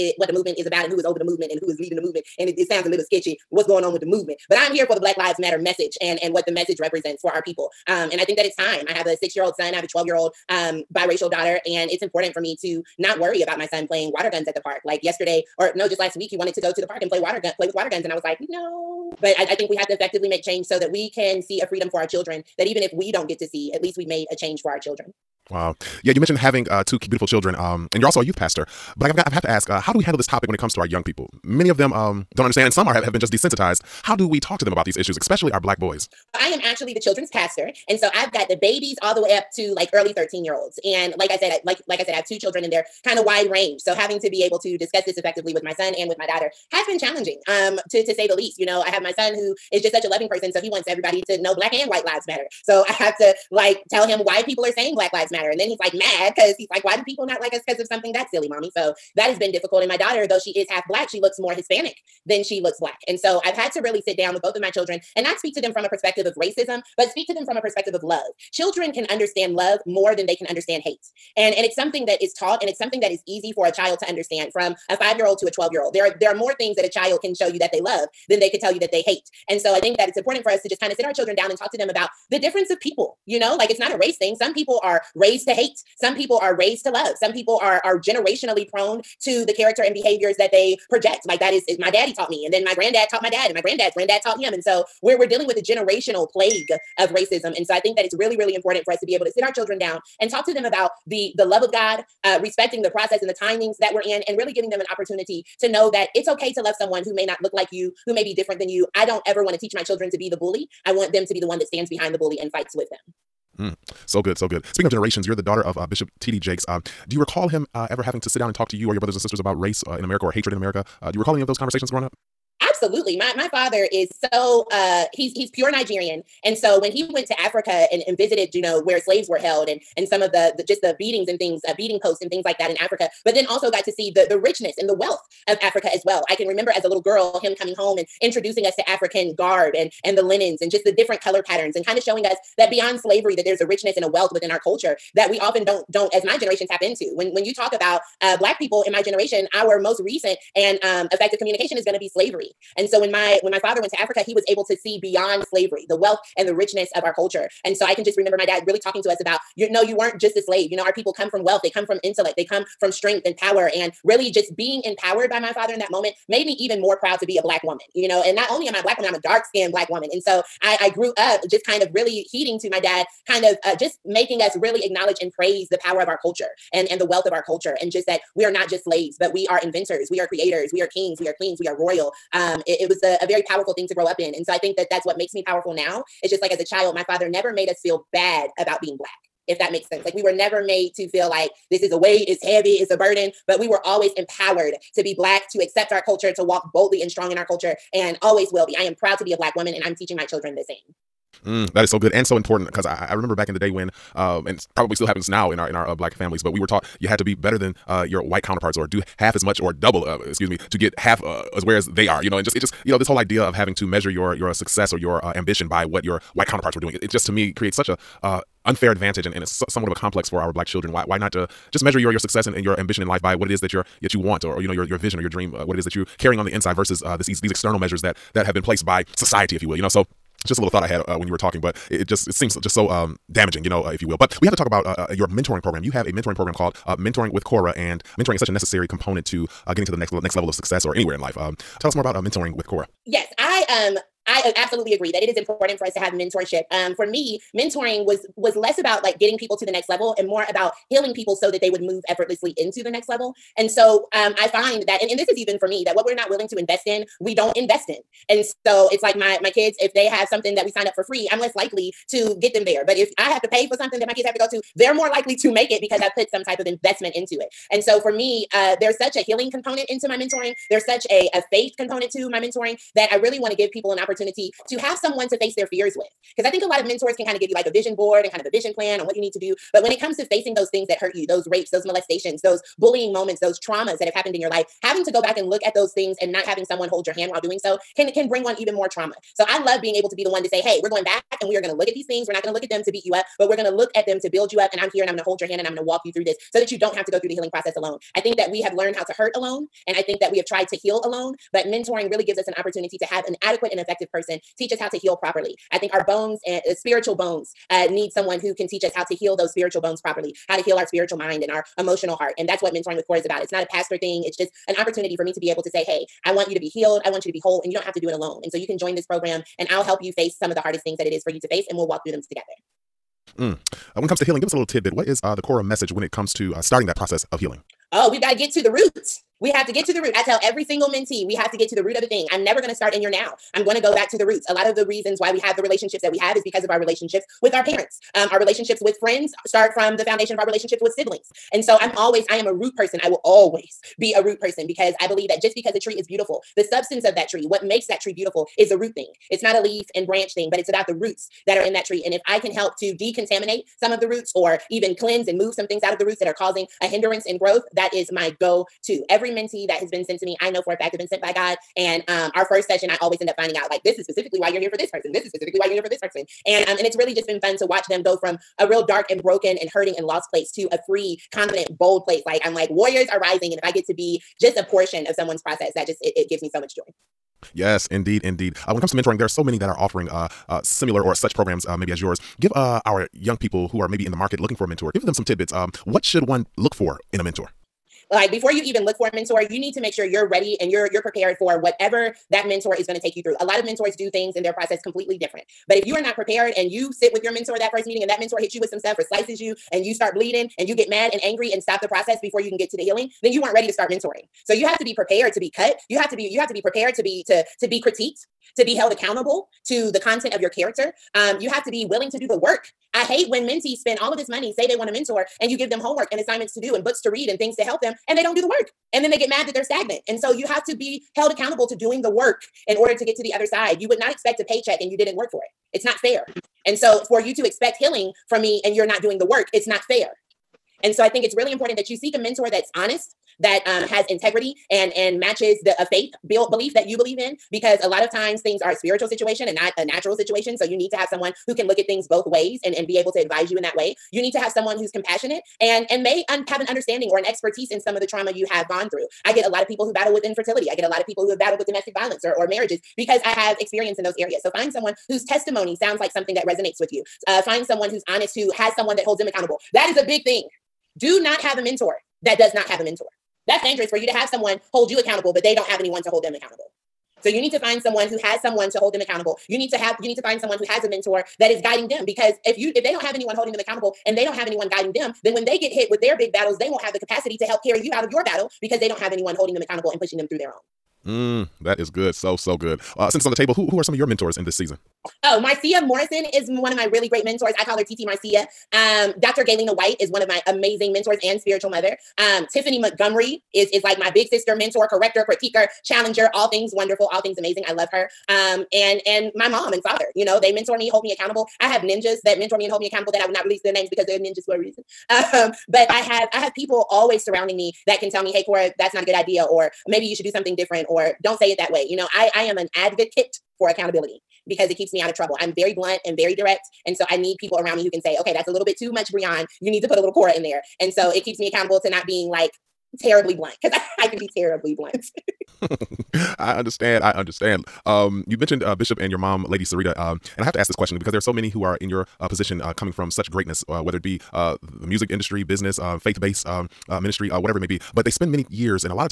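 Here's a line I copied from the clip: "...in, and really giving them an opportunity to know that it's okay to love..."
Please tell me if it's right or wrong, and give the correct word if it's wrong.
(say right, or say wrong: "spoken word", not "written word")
right.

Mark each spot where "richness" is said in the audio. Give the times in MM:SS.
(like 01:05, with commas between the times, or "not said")
02:14, 02:23, 02:36.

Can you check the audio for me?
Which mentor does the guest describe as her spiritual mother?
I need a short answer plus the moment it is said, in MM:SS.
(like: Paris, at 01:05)
Dr. Galena White, at 08:09.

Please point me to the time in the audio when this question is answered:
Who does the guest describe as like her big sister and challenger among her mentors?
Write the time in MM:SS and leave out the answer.
08:12.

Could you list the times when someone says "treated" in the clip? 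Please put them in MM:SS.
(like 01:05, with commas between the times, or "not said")
not said.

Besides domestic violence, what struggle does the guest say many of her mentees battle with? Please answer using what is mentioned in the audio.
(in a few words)
Infertility.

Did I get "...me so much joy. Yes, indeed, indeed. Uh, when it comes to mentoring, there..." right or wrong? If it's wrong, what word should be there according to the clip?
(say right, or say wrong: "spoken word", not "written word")
right.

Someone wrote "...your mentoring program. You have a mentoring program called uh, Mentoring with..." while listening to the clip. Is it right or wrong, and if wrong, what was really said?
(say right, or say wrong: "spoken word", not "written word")
right.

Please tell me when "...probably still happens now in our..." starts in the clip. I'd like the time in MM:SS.
03:24.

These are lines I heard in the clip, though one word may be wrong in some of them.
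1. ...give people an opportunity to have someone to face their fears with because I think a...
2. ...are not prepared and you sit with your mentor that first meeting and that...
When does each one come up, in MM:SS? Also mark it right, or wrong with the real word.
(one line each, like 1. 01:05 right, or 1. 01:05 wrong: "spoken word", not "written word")
1. 04:33 right
2. 06:35 right.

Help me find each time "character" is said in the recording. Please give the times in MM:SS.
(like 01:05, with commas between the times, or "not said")
01:29, 06:50.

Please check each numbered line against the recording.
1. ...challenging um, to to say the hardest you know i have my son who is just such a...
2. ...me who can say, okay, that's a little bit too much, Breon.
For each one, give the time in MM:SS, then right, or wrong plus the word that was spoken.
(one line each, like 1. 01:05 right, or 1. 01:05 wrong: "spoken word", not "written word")
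1. 00:46 wrong: "least", not "hardest"
2. 08:37 right.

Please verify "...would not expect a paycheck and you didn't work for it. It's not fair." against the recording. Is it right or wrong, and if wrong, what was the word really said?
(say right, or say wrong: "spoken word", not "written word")
right.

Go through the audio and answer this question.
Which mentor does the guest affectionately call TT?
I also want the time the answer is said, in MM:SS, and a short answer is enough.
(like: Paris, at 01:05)
Marcia Morrison, at 08:05.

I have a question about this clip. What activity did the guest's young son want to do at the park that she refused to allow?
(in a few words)
Play with water guns.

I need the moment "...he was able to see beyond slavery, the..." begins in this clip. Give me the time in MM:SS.
02:34.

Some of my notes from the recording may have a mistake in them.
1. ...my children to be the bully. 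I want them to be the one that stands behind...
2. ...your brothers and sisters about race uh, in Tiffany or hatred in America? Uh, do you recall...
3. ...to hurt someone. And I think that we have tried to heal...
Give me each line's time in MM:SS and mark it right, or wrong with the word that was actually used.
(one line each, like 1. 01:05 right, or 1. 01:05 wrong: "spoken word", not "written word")
1. 01:49 right
2. 01:58 wrong: "America", not "Tiffany"
3. 04:59 wrong: "alone", not "someone".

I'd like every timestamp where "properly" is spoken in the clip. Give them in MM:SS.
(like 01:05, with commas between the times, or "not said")
05:05, 05:10.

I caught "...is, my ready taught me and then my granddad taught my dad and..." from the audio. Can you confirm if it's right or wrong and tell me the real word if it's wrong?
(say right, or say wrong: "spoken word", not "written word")
wrong: "daddy", not "ready".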